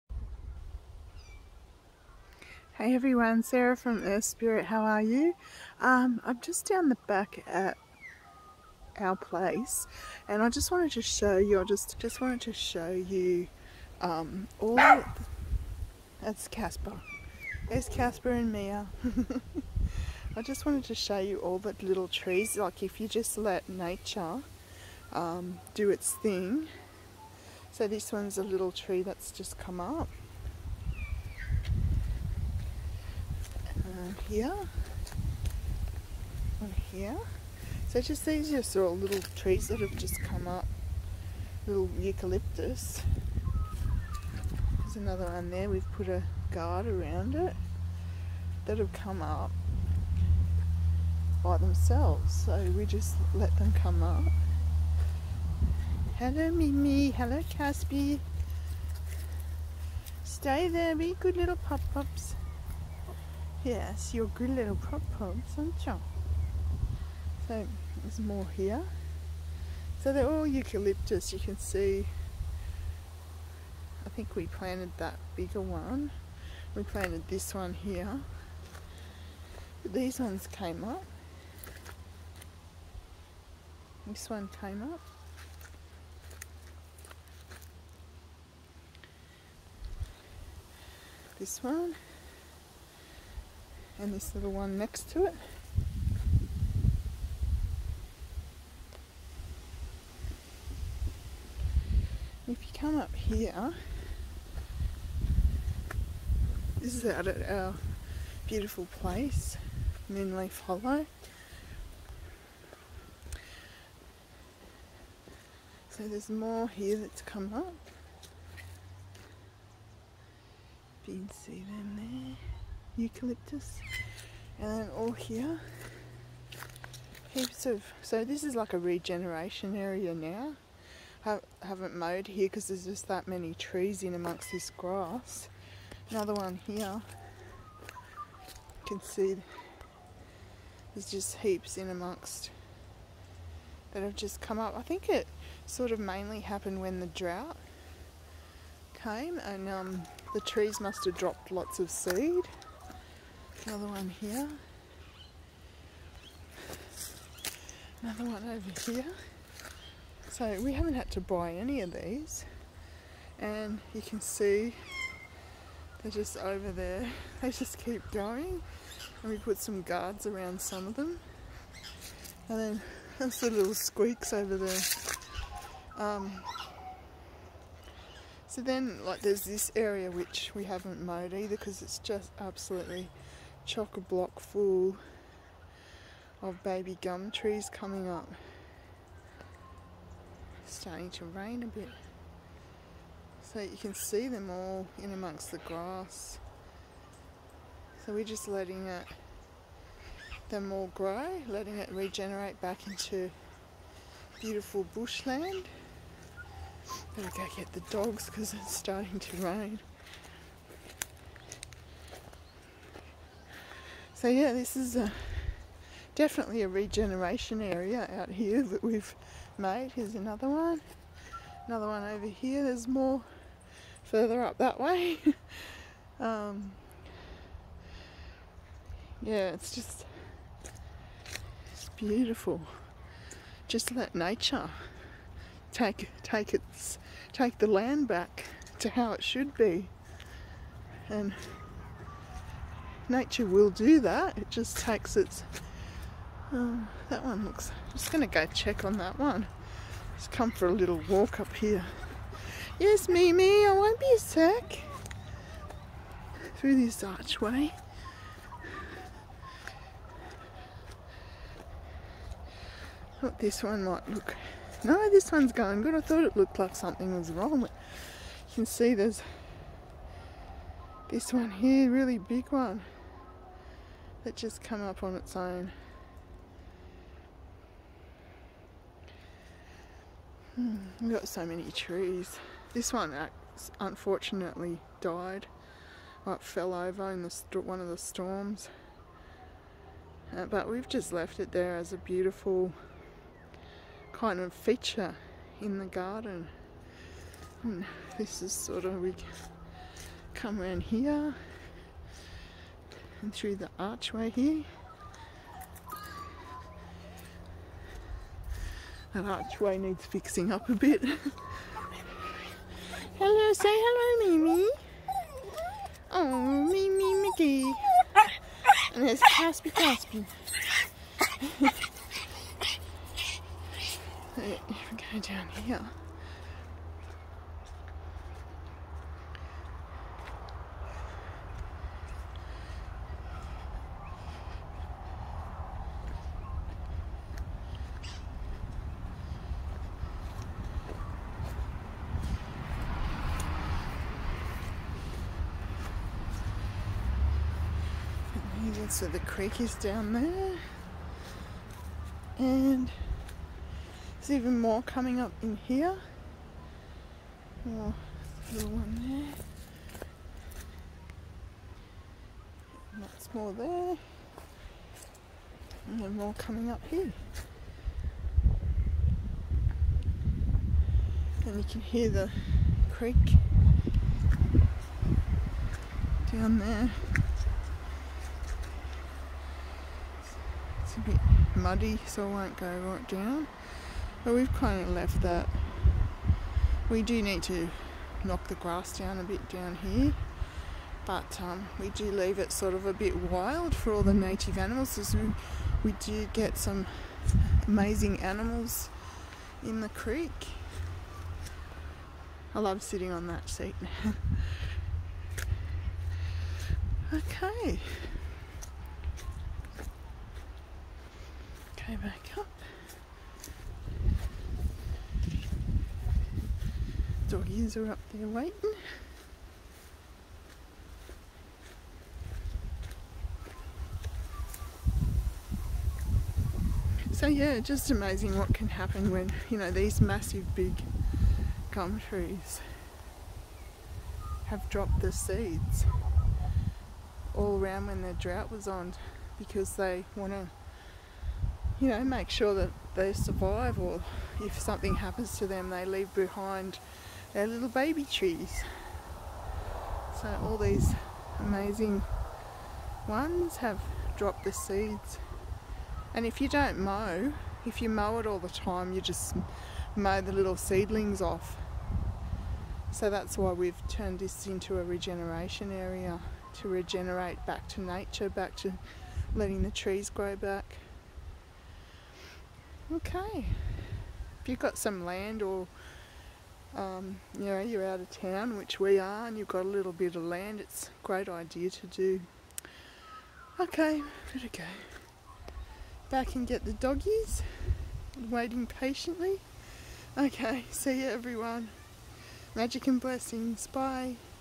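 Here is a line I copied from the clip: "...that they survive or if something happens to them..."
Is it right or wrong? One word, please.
right.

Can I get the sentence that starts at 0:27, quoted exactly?
So this one's a little tree that's just come up.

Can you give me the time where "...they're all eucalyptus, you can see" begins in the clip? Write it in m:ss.
1:10.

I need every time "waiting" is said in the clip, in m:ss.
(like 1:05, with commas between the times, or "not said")
6:58, 8:08.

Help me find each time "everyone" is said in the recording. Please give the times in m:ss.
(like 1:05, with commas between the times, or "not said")
0:02, 8:11.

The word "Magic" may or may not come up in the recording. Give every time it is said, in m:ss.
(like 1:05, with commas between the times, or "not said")
8:12.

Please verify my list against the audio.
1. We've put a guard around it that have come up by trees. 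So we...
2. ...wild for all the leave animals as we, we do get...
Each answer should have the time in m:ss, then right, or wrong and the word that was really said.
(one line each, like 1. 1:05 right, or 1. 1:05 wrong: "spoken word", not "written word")
1. 0:45 wrong: "themselves", not "trees"
2. 6:33 wrong: "native", not "leave".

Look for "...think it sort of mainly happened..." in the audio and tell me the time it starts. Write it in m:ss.
2:24.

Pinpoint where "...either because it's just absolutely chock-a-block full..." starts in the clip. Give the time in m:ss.
3:01.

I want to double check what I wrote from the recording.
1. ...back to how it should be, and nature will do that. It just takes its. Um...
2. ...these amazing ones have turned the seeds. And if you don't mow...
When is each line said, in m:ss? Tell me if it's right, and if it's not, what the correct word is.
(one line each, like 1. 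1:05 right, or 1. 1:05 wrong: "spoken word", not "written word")
1. 3:58 right
2. 7:30 wrong: "dropped", not "turned".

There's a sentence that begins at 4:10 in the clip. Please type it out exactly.
Just come for a little walk up here.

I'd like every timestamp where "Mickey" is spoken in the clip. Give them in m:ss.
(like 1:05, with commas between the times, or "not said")
5:17.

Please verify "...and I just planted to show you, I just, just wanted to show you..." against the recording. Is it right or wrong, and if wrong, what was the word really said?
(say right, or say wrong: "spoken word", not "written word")
wrong: "wanted", not "planted".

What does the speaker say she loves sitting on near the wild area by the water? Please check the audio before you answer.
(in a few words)
that seat.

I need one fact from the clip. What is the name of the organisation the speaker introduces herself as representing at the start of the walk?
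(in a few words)
Earth Spirit.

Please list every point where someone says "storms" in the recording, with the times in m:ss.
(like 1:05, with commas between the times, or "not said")
4:47.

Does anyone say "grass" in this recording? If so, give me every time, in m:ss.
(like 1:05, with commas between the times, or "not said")
2:14, 3:15, 6:28.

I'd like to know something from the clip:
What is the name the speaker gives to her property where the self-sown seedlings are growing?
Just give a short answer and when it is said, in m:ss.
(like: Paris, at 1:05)
Moonleaf Hollow, at 1:50.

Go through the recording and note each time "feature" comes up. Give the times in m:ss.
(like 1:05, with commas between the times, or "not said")
4:54.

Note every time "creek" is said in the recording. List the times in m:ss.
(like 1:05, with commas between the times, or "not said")
5:49, 6:12, 6:39.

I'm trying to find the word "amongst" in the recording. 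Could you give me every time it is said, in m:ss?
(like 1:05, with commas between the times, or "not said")
2:14, 2:21, 3:15.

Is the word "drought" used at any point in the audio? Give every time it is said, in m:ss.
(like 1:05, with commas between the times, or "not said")
2:27, 7:18.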